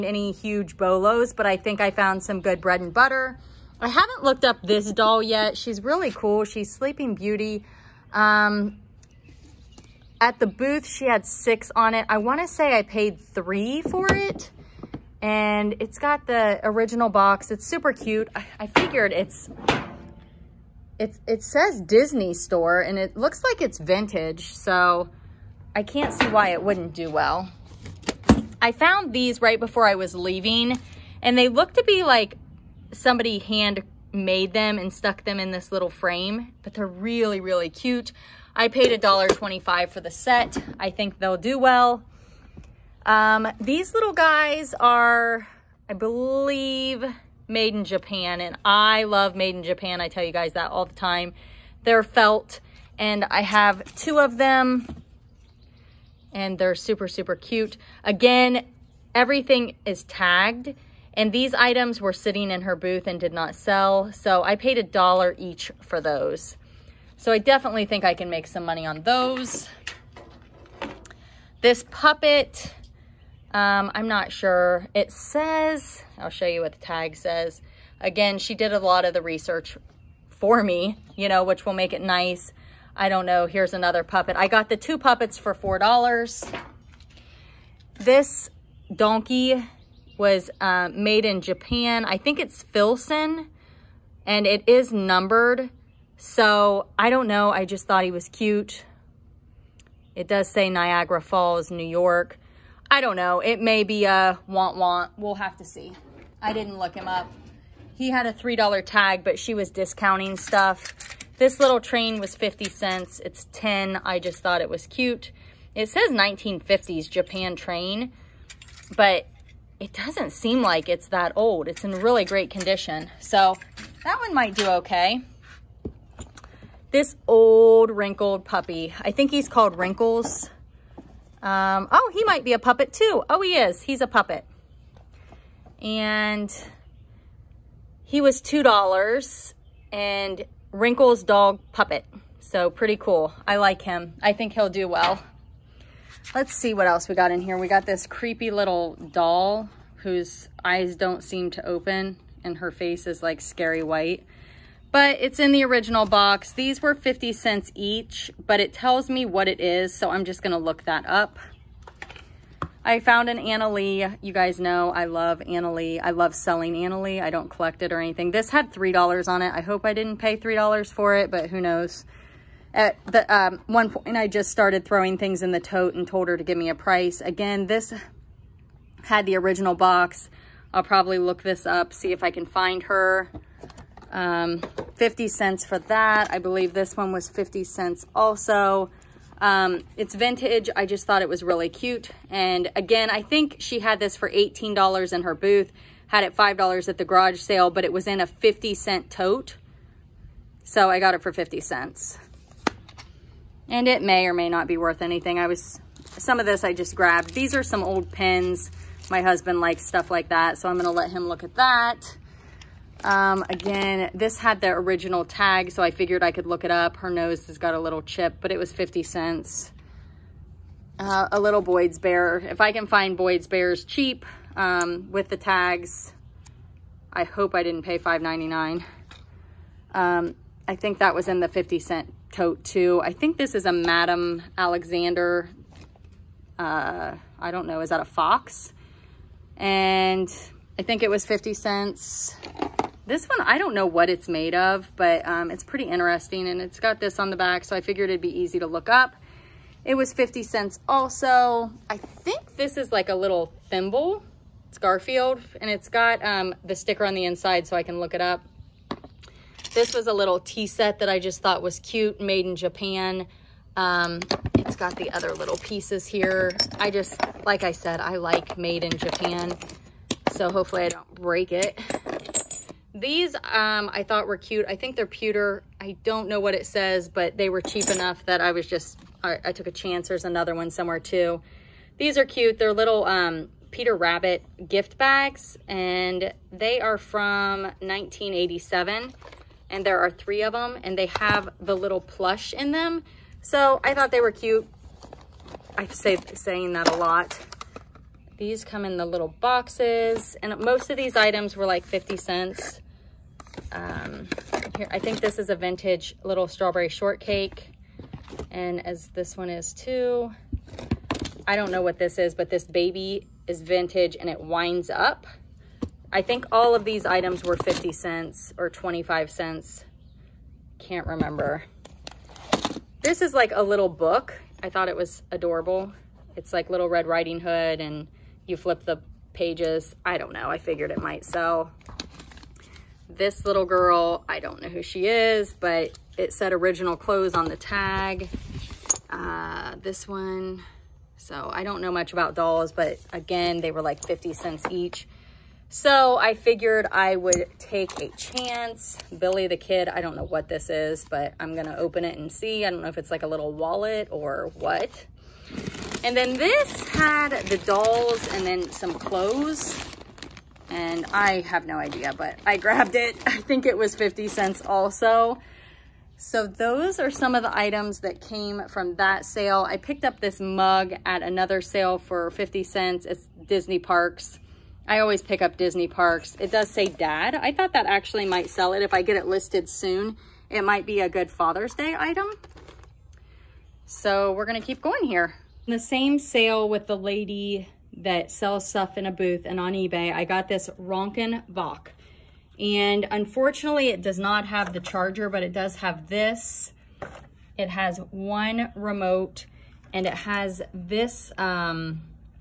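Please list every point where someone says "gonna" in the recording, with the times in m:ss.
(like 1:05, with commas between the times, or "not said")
2:40, 3:30, 5:51, 6:24.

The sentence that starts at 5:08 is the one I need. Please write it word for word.
And as this one is too, I don't know what this is, but this baby is vintage and it winds up.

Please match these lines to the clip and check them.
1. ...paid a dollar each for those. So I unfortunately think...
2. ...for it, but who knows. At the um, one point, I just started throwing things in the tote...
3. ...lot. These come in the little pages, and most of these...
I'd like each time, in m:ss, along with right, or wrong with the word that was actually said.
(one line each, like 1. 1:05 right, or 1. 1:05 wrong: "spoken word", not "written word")
1. 1:04 wrong: "definitely", not "unfortunately"
2. 2:50 right
3. 4:56 wrong: "boxes", not "pages".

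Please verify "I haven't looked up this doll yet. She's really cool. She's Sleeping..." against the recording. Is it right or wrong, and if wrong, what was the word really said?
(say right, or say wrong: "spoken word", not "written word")
right.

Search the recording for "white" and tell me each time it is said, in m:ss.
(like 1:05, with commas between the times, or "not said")
2:33.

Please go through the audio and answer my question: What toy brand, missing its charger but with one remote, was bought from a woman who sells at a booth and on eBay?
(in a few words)
Rokenbok.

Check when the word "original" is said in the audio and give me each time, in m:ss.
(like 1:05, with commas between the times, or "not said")
0:16, 2:35, 2:59, 3:34, 5:36.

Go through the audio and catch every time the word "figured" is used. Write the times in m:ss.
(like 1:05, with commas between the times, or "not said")
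0:18, 3:35, 4:07, 5:30, 5:46.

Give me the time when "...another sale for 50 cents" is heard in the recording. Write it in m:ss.
6:11.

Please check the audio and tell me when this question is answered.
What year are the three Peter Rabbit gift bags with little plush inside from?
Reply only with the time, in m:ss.
4:47.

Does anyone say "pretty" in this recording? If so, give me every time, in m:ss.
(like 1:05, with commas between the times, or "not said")
2:22, 4:05.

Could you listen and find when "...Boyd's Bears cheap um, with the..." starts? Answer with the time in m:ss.
3:43.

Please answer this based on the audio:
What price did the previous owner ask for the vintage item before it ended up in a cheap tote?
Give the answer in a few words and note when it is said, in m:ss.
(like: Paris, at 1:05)
$18, at 3:14.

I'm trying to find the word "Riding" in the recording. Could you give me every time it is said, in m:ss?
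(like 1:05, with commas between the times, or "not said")
5:27.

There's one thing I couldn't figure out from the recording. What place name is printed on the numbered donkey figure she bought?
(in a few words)
Niagara Falls, New York.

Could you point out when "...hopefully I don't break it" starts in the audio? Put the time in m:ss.
4:30.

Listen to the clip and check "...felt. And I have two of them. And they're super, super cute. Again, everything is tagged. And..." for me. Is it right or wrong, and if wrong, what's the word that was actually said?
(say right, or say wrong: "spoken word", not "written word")
right.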